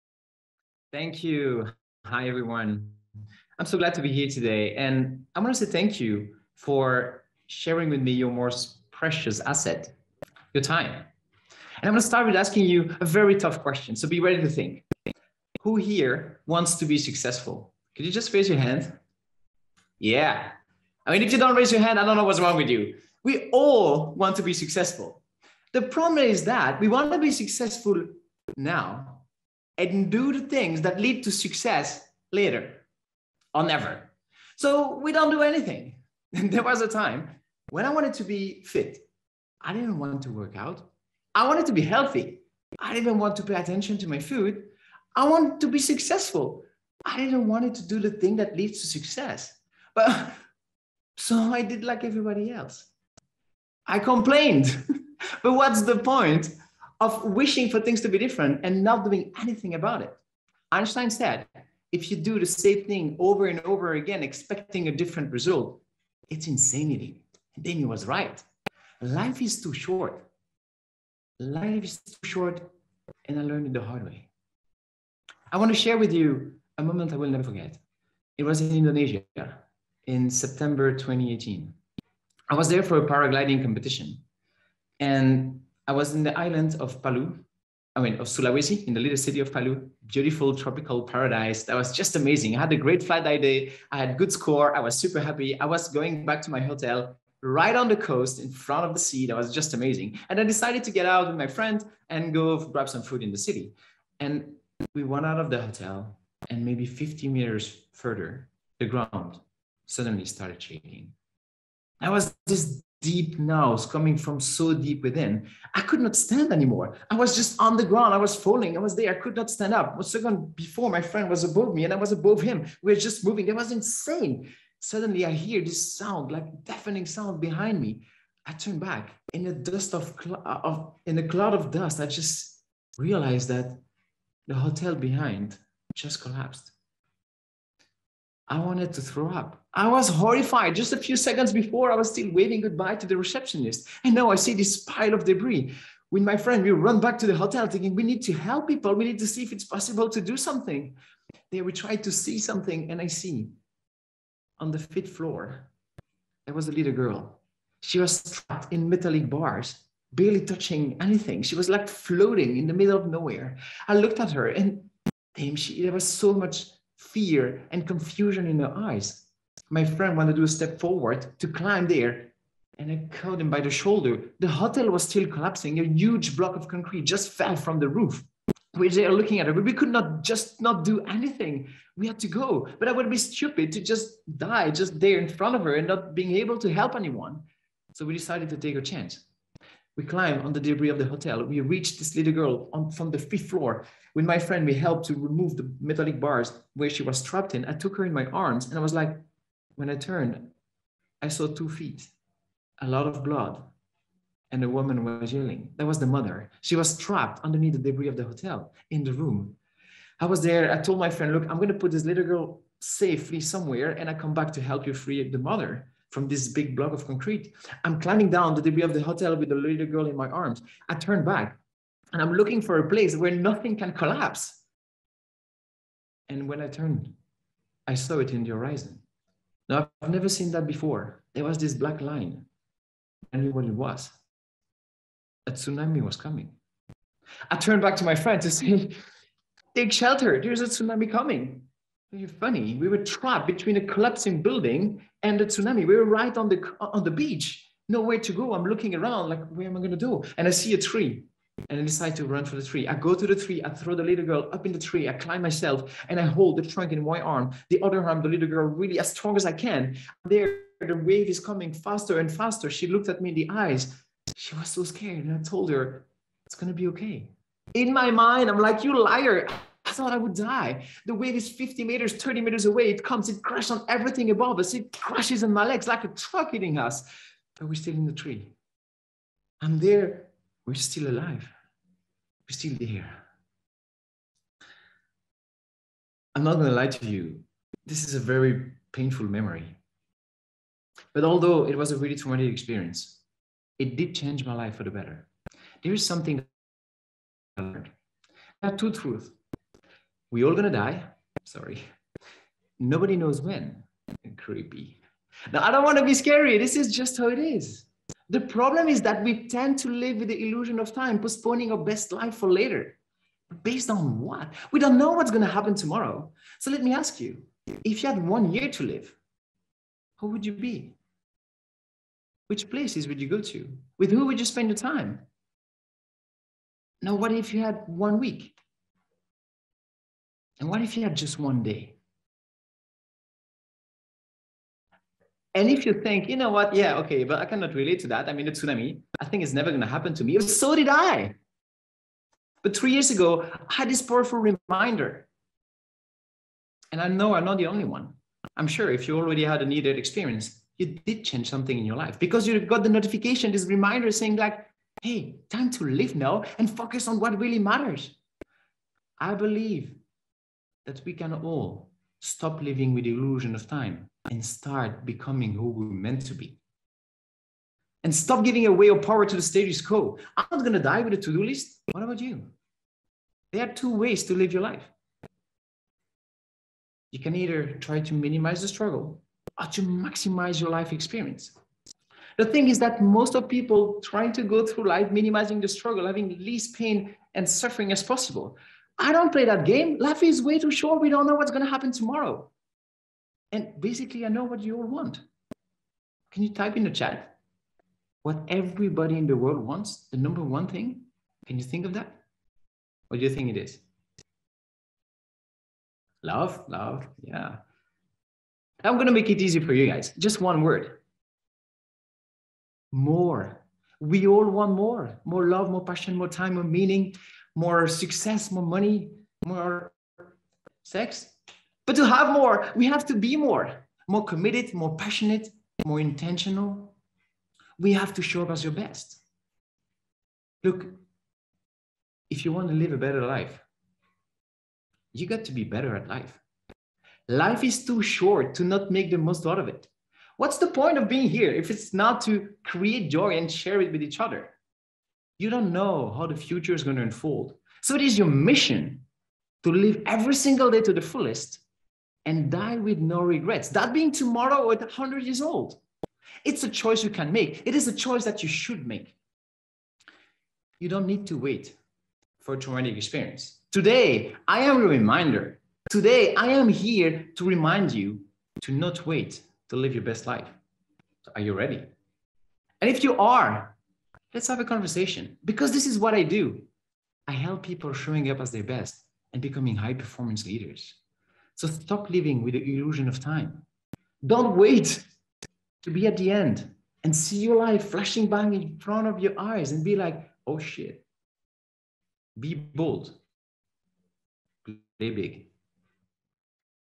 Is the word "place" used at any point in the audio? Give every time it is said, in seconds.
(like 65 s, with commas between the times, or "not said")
222 s, 322 s.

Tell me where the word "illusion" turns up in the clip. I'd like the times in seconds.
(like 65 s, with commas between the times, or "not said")
310 s, 363 s, 482 s.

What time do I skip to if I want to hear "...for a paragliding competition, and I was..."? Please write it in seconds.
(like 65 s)
82 s.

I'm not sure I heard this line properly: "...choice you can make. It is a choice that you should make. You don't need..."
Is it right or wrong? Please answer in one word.
right.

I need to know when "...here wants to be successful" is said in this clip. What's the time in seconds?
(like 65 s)
15 s.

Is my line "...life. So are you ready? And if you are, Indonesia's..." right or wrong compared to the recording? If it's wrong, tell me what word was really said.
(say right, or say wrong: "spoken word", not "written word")
wrong: "Let", not "Indonesia".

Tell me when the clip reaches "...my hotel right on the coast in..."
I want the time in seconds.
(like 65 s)
96 s.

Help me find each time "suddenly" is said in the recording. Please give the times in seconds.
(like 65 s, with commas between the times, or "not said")
109 s, 124 s.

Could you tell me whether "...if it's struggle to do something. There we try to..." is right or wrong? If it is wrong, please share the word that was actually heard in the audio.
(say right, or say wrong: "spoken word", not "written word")
wrong: "possible", not "struggle".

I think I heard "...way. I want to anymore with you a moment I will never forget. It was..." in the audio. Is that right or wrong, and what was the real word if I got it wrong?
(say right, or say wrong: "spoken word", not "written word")
wrong: "share", not "anymore".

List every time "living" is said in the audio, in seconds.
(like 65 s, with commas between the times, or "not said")
362 s, 482 s.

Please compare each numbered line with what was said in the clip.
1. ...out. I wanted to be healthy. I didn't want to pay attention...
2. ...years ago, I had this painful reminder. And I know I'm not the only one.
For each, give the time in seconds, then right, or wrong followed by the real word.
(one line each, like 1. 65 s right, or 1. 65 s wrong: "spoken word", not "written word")
1. 40 s right
2. 342 s wrong: "powerful", not "painful".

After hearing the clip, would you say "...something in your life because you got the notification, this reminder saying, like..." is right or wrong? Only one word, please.
right.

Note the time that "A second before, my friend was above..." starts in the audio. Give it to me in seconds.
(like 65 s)
119 s.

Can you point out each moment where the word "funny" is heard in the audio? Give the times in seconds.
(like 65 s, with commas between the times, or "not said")
242 s.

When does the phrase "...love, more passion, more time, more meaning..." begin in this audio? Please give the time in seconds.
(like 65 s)
415 s.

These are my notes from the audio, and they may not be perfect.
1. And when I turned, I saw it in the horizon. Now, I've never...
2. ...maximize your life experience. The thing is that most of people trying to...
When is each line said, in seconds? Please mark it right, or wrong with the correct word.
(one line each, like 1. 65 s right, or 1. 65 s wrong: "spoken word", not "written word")
1. 226 s right
2. 379 s right.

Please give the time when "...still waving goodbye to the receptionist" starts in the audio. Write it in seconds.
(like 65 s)
142 s.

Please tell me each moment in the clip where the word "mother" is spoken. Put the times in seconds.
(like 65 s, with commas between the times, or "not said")
206 s, 215 s.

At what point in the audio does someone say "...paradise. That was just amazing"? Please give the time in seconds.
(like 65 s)
91 s.